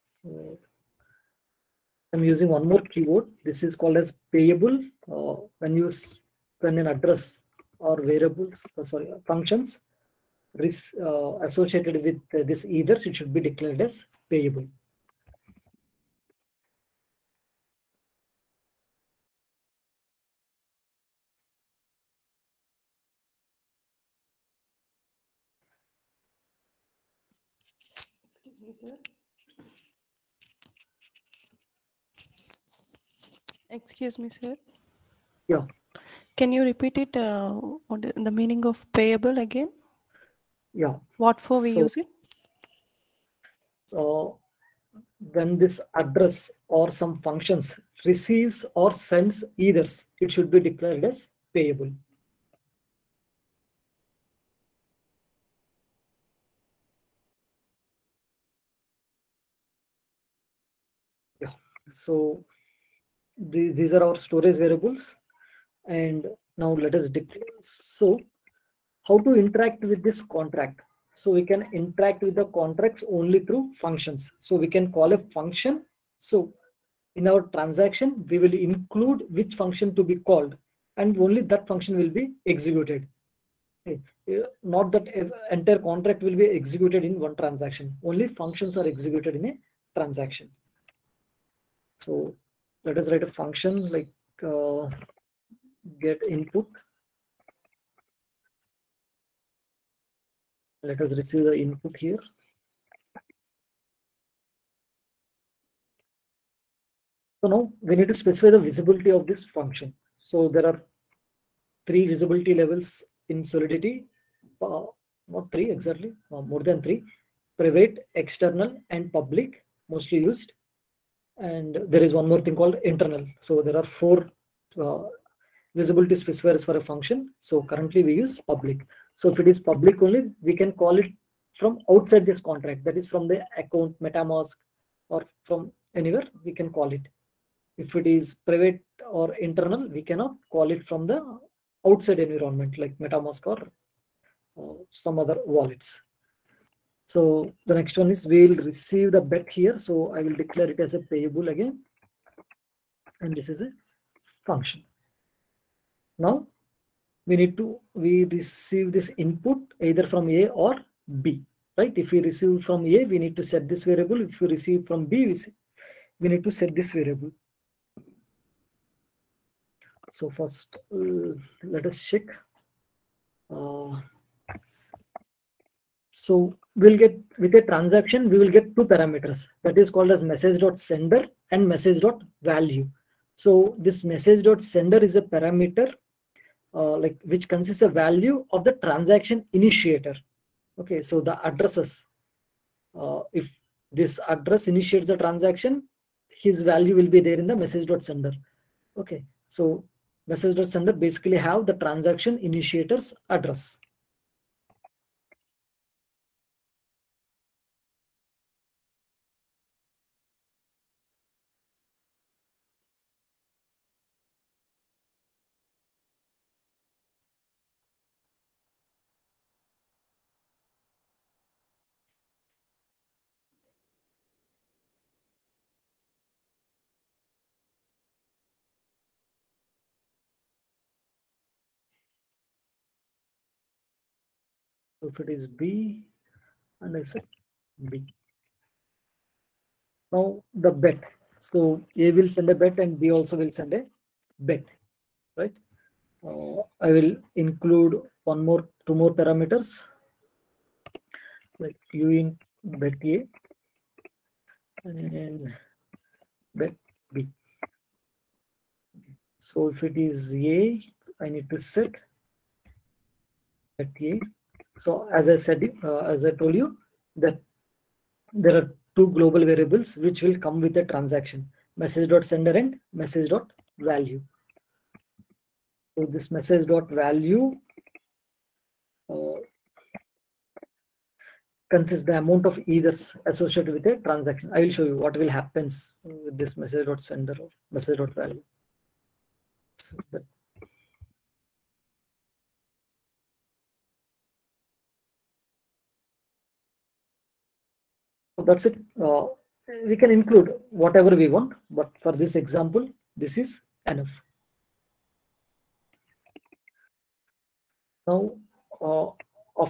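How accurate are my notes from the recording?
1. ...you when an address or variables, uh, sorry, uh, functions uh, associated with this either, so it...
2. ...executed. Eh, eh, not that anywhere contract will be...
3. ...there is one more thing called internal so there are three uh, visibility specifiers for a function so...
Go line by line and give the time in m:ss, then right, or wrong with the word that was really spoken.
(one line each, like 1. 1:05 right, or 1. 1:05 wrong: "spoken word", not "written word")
1. 0:05 wrong: "ether", not "either"
2. 1:22 wrong: "entire", not "anywhere"
3. 2:01 wrong: "four", not "three".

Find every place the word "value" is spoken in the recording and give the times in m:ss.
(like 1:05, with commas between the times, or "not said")
3:02, 3:07, 3:16, 4:33.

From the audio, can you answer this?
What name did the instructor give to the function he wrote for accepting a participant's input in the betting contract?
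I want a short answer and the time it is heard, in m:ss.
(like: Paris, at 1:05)
get input, at 1:36.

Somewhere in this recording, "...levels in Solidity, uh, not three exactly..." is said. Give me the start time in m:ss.
1:52.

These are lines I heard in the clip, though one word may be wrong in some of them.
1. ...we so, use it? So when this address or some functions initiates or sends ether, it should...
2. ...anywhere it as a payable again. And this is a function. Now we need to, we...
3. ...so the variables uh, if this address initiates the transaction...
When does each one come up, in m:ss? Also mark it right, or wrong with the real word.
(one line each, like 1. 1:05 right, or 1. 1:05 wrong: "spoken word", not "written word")
1. 0:41 wrong: "receives", not "initiates"
2. 2:30 wrong: "declare", not "anywhere"
3. 3:11 wrong: "addresses", not "variables".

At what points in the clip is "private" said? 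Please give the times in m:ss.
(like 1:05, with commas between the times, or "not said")
1:57, 2:18.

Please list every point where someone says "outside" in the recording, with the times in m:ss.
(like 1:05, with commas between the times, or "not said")
2:11, 2:21.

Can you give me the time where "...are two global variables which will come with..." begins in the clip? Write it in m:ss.
4:28.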